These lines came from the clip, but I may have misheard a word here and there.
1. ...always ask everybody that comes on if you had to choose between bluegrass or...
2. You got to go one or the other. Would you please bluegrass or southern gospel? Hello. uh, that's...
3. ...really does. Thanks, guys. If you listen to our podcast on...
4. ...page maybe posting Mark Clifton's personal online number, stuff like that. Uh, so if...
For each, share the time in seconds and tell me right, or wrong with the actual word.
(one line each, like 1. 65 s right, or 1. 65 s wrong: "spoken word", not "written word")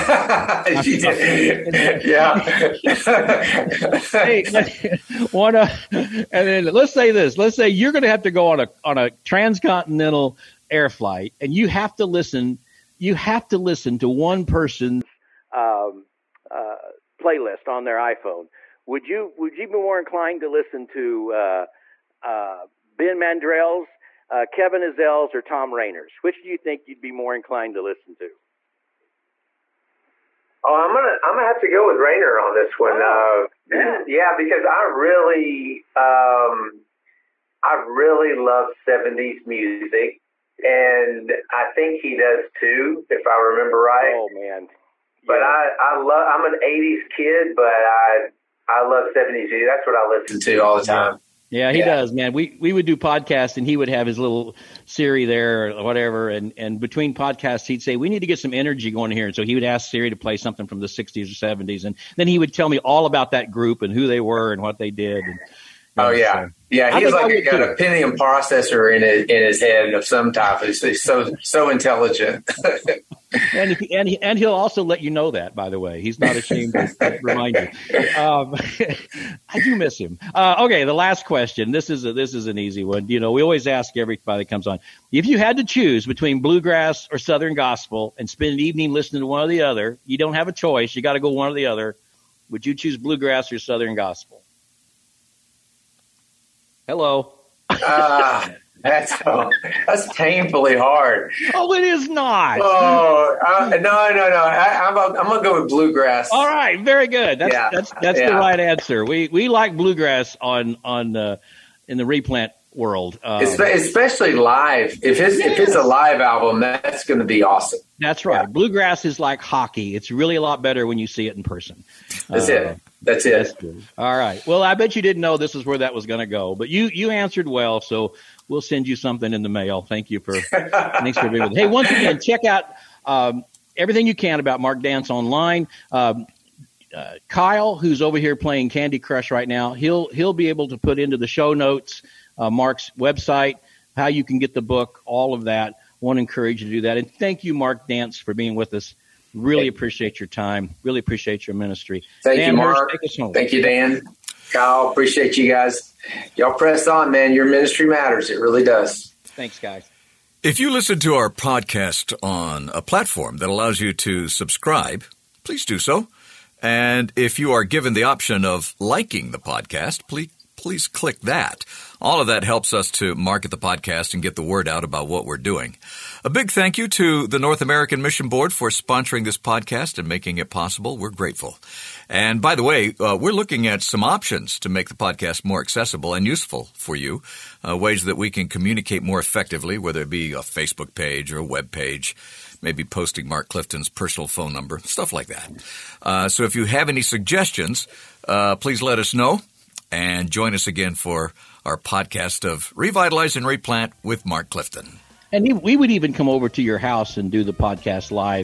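1. 83 s right
2. 90 s wrong: "choose", not "please"
3. 158 s right
4. 191 s wrong: "phone", not "online".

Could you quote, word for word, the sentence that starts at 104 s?
I, am I'm, I'm gonna go with bluegrass.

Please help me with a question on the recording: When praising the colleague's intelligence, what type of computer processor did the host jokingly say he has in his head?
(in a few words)
Pentium.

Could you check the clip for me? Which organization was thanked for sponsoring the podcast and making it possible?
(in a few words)
North American Mission Board.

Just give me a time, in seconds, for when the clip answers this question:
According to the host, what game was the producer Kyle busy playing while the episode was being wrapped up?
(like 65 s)
138 s.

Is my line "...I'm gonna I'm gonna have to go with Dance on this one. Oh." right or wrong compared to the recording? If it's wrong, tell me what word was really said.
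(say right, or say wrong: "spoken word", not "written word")
wrong: "Rayner", not "Dance".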